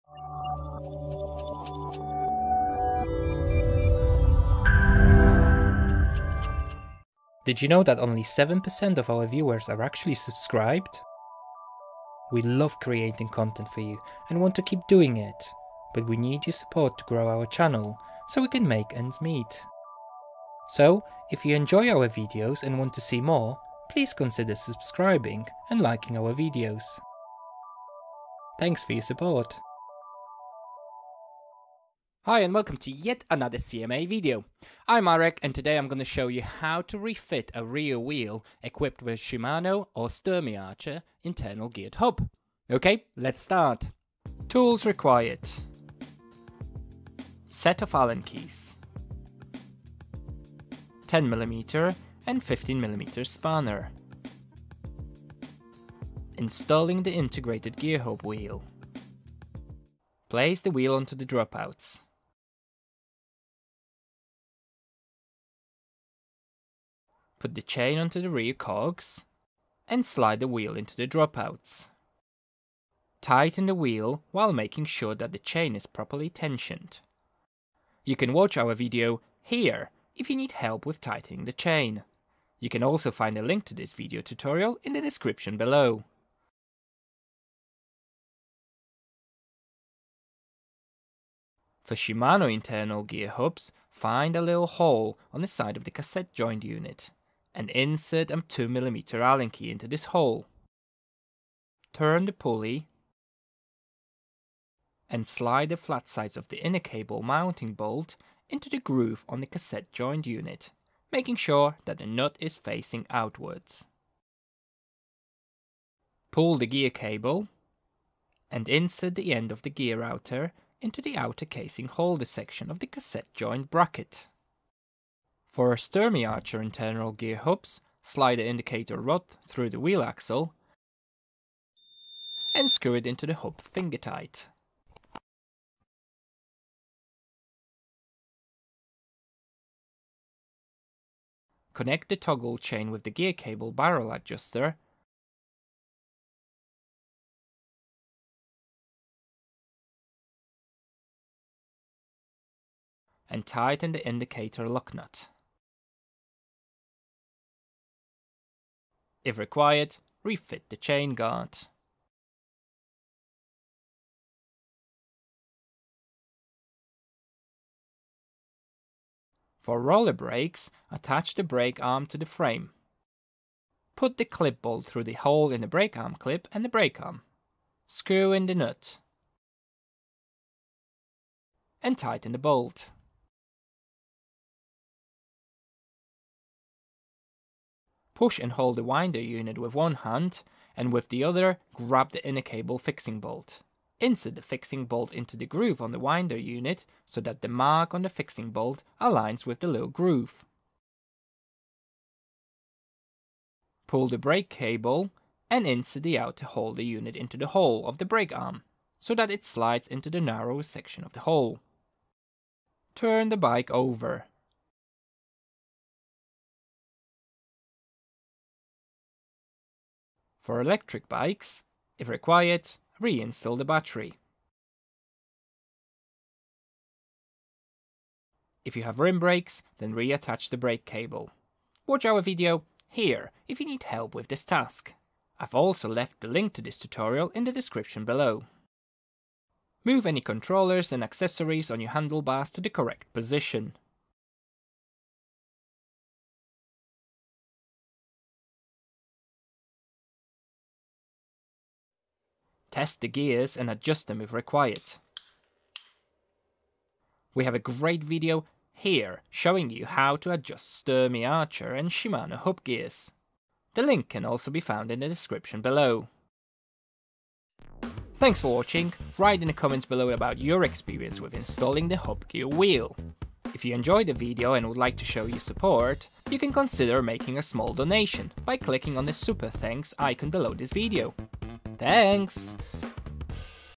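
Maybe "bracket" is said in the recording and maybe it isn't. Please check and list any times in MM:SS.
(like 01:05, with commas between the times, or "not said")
02:03.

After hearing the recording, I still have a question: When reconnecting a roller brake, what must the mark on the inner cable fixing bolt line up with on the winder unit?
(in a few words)
little groove.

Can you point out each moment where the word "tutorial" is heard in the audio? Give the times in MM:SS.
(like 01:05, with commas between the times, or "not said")
01:24, 03:56.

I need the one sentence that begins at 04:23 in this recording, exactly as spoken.
The link can also be found in the description below.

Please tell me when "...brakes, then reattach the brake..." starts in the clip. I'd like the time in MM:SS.
03:49.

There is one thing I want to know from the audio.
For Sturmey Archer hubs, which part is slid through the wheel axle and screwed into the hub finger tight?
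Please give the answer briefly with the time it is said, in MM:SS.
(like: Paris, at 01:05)
indicator rod, at 02:08.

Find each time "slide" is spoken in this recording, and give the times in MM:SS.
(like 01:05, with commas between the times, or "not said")
01:10, 01:45, 02:08, 03:29.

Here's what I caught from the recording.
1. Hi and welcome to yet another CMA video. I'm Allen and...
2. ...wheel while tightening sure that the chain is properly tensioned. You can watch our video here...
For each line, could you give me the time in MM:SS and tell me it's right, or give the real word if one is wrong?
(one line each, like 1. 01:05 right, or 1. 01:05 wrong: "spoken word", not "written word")
1. 00:32 wrong: "Marek", not "Allen"
2. 01:13 wrong: "making", not "tightening".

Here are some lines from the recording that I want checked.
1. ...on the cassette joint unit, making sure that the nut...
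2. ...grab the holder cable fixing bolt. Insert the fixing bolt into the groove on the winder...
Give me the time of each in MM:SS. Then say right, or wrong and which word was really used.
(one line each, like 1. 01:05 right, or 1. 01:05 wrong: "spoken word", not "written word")
1. 01:49 right
2. 03:11 wrong: "inner", not "holder".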